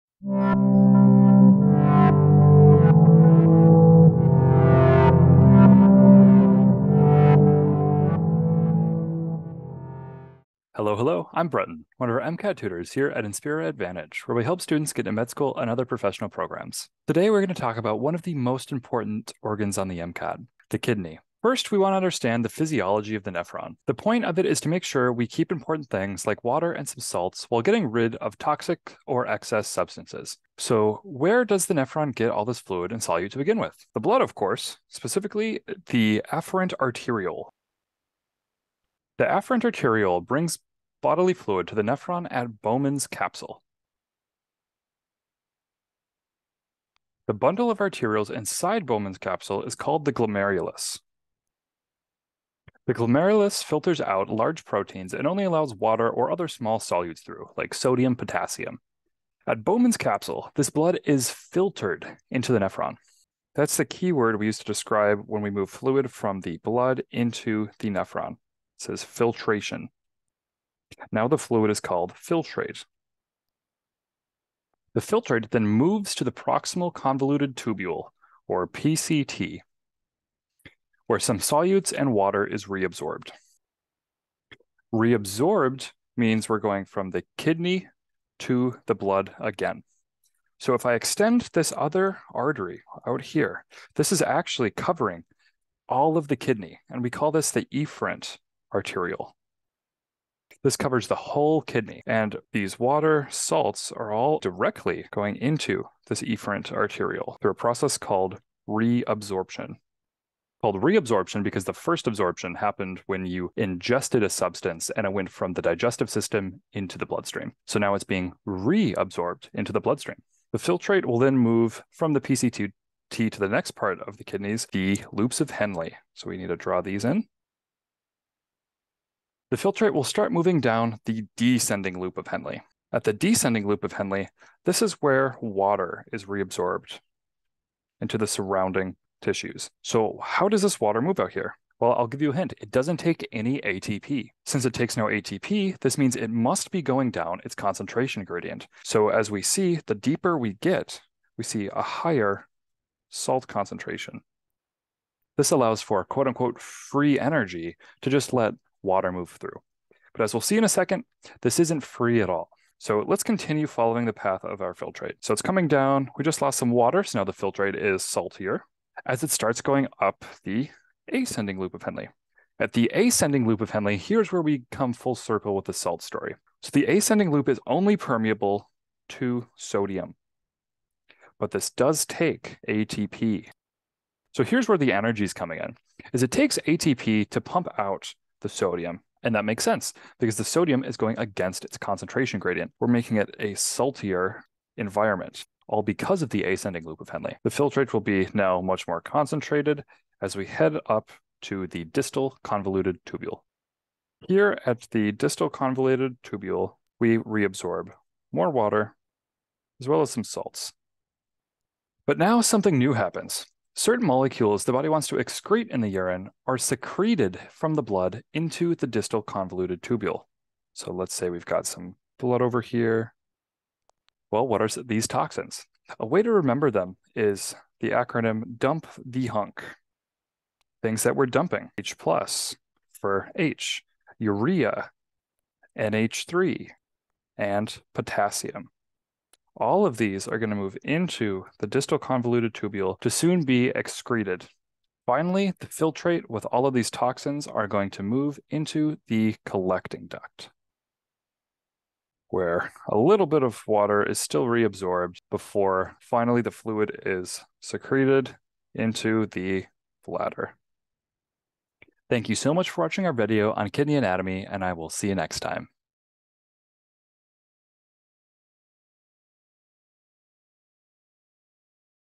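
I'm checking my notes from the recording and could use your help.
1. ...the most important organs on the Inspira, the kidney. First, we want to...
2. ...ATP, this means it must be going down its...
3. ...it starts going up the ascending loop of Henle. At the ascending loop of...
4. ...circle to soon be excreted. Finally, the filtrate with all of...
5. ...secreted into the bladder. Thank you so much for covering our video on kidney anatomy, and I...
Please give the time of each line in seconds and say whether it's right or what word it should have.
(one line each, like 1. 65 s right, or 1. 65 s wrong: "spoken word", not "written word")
1. 18 s wrong: "MCAT", not "Inspira"
2. 145 s right
3. 169 s right
4. 242 s wrong: "tubule", not "circle"
5. 257 s wrong: "watching", not "covering".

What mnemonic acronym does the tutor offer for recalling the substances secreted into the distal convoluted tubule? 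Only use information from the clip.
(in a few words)
dump the hunk.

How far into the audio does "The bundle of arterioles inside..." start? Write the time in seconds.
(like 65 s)
47 s.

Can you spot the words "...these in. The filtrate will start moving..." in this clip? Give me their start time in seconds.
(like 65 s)
126 s.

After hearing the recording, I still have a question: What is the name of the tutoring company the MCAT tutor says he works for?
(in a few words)
Inspira Advantage.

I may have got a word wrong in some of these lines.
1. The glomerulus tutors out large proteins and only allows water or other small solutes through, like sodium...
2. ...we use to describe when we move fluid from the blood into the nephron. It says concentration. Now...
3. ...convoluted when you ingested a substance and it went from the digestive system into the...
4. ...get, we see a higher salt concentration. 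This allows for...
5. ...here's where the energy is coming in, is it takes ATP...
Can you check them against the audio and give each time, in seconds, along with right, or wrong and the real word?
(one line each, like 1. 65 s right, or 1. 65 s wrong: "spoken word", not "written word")
1. 52 s wrong: "filters", not "tutors"
2. 64 s wrong: "filtration", not "concentration"
3. 112 s wrong: "happened", not "convoluted"
4. 150 s right
5. 184 s right.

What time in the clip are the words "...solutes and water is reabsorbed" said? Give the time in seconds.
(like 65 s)
81 s.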